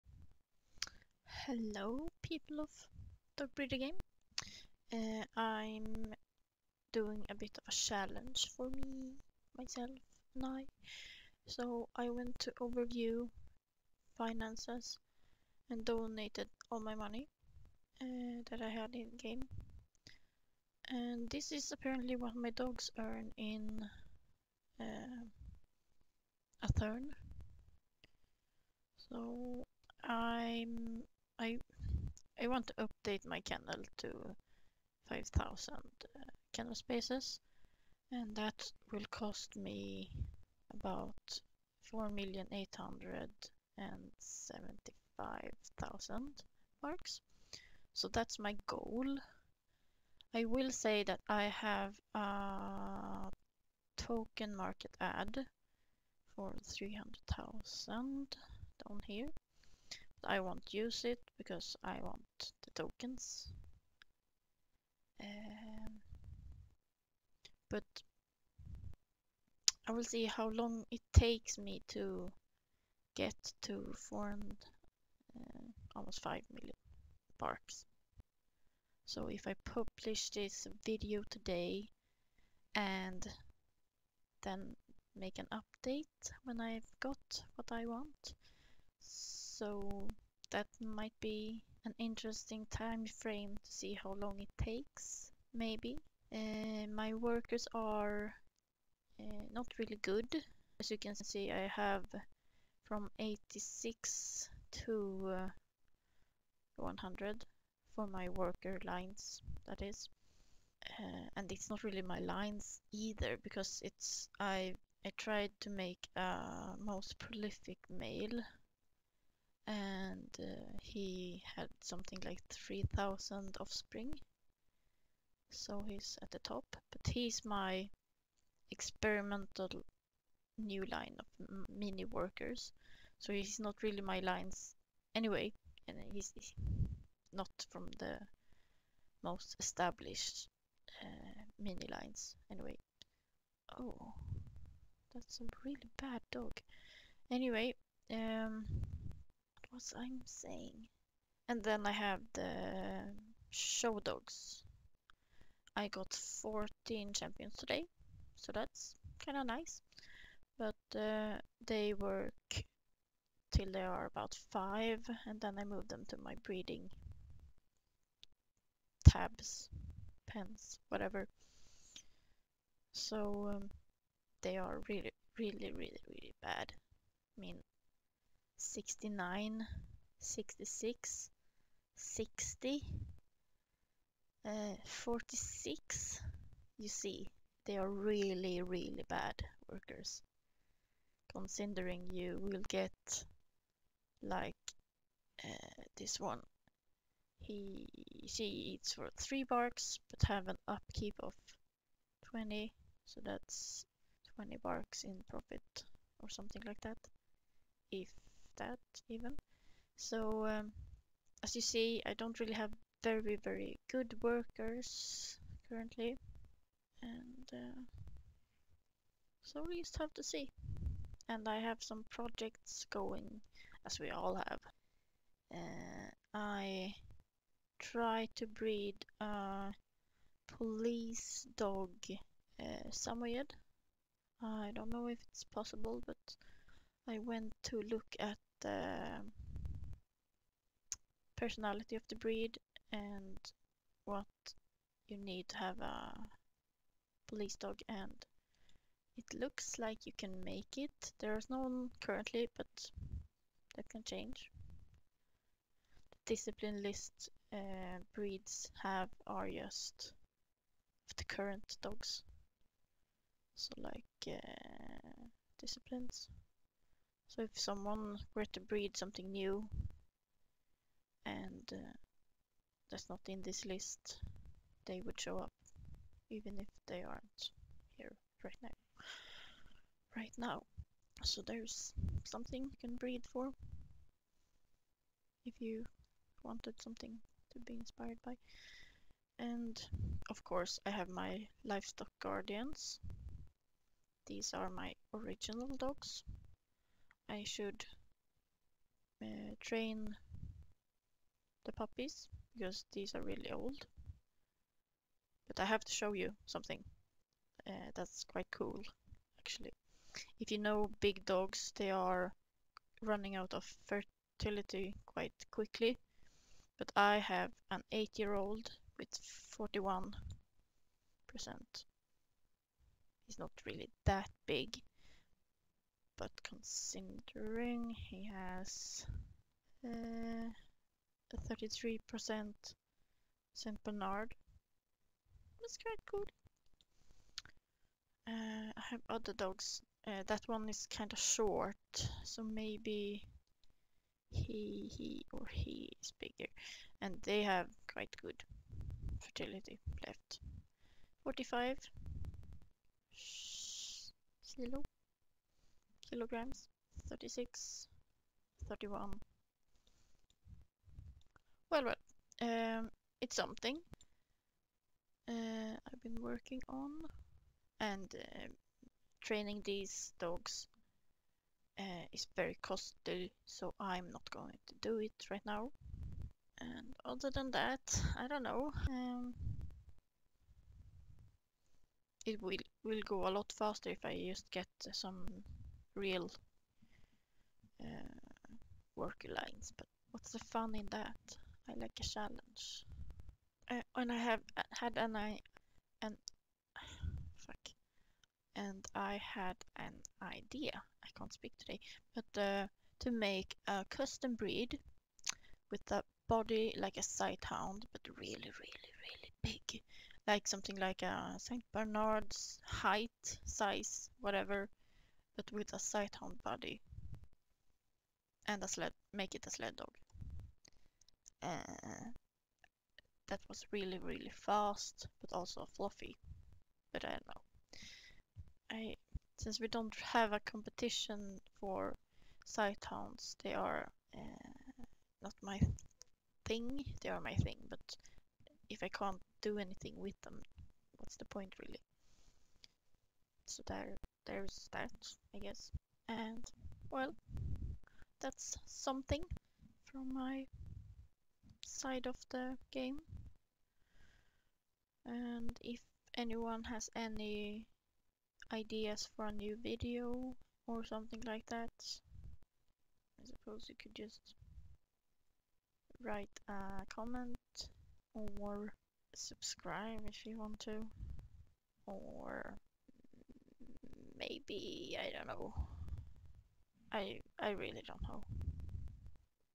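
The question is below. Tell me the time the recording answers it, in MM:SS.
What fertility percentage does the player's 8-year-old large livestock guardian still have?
05:19.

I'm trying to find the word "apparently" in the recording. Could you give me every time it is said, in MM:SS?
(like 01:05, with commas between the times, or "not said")
00:21.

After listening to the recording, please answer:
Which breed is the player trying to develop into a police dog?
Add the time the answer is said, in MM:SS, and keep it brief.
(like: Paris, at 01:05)
Samoyed, at 03:52.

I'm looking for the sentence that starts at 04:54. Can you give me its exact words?
These are my original dogs I should uh, train the puppies because these are really old.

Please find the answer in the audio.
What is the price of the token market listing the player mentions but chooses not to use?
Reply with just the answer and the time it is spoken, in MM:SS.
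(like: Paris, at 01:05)
300,000, at 00:56.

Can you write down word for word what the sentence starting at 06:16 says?
And other than that, I don't know.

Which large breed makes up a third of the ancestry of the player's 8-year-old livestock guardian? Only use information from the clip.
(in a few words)
St. Bernard.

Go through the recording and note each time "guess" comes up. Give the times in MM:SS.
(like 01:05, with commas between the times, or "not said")
07:25.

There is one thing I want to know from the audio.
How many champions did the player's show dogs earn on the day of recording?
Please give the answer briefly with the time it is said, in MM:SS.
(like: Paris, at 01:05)
14, at 02:36.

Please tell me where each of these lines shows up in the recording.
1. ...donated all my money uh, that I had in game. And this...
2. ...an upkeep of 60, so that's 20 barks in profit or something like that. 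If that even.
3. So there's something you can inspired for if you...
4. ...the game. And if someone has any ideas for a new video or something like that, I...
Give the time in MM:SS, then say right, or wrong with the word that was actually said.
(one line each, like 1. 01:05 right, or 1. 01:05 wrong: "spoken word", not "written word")
1. 00:15 right
2. 03:20 wrong: "20", not "60"
3. 04:41 wrong: "breed", not "inspired"
4. 07:32 wrong: "anyone", not "someone".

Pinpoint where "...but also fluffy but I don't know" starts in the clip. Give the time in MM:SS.
07:05.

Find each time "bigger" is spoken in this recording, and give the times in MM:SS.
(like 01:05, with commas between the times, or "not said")
05:46.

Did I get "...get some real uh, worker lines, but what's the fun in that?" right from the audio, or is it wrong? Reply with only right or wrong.
right.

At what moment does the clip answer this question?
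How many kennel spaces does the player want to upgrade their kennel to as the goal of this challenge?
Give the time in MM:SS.
00:35.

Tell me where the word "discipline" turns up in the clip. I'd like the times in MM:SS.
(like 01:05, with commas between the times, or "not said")
04:16, 04:25.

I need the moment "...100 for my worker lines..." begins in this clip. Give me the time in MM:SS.
01:46.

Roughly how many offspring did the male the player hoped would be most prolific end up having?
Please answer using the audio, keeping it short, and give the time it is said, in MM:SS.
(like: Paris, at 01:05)
3000, at 02:02.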